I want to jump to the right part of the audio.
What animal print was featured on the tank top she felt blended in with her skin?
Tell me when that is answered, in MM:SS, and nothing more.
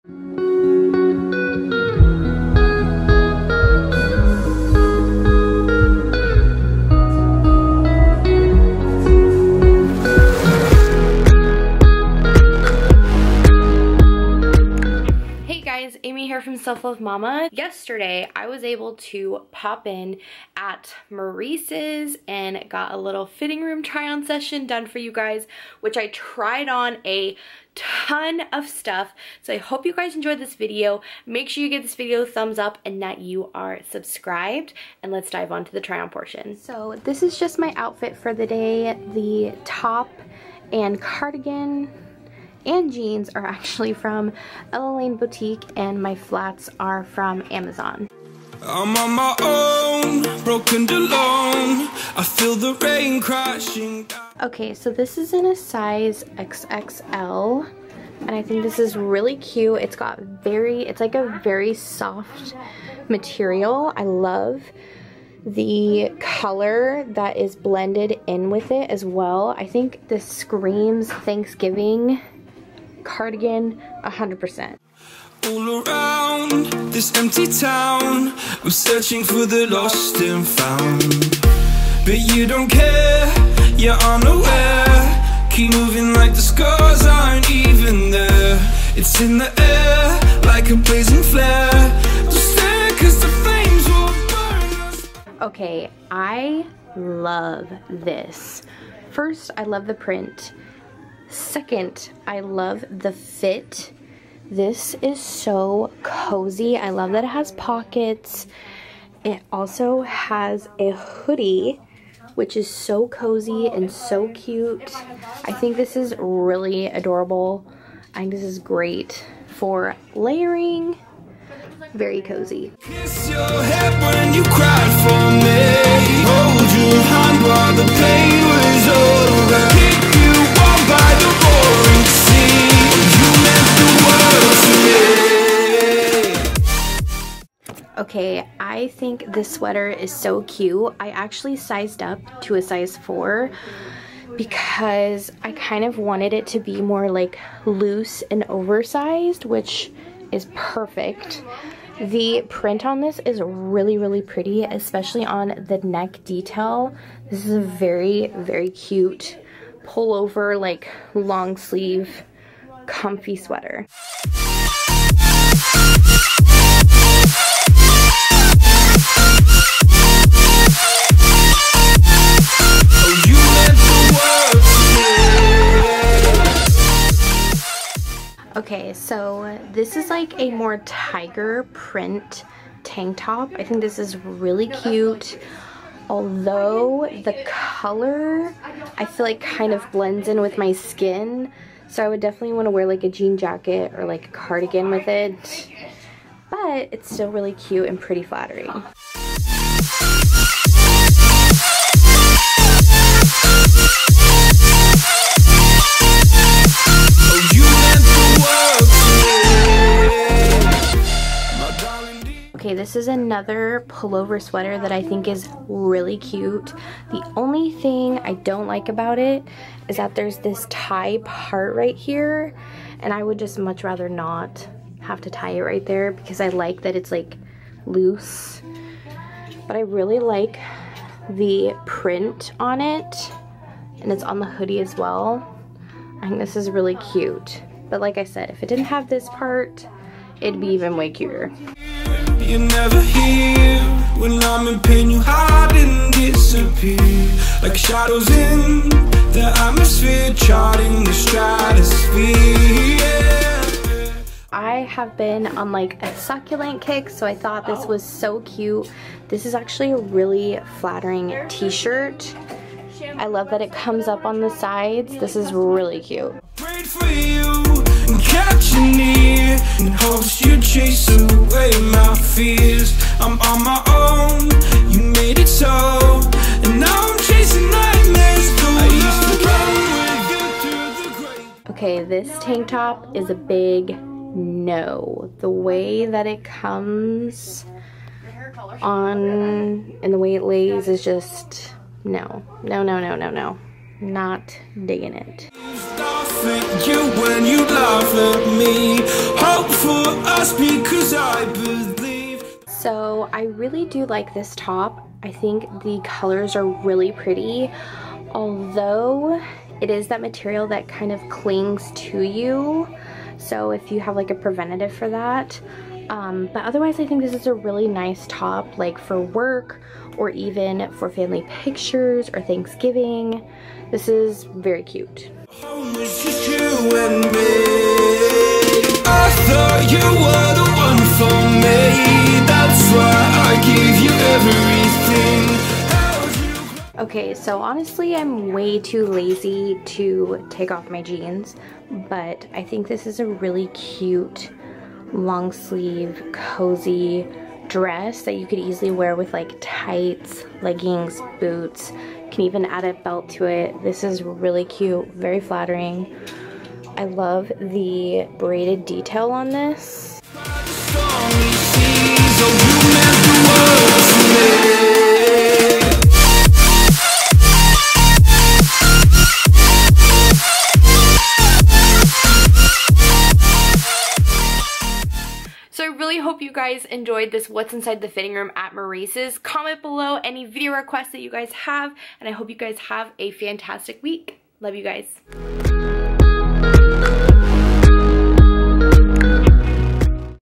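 03:00.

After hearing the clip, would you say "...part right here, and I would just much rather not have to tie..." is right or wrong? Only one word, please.
right.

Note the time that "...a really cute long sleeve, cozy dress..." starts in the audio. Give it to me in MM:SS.
05:43.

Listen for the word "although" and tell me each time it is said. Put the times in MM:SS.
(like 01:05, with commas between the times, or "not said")
03:06, 05:08.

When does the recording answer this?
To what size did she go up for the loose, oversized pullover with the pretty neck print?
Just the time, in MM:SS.
02:22.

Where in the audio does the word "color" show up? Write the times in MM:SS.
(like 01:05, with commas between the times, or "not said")
01:06, 03:07, 05:06.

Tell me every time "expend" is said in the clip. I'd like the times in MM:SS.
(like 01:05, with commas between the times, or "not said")
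not said.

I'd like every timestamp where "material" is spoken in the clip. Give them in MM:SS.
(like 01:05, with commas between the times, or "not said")
01:03, 05:10.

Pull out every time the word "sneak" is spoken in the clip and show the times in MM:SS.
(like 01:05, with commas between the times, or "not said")
not said.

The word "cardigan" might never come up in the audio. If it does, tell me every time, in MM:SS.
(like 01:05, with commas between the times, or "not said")
00:40, 01:13, 03:14.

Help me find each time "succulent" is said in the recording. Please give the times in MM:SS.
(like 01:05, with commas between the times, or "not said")
04:16.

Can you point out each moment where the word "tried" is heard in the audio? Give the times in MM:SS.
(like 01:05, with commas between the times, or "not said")
00:26.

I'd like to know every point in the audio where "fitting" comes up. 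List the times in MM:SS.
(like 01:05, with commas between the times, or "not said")
00:23, 06:18.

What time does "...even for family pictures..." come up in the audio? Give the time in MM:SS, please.
05:20.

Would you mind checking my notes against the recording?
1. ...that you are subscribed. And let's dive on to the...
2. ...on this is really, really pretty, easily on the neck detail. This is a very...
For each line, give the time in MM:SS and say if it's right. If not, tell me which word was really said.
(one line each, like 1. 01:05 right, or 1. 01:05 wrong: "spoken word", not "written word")
1. 00:33 right
2. 02:32 wrong: "especially", not "easily".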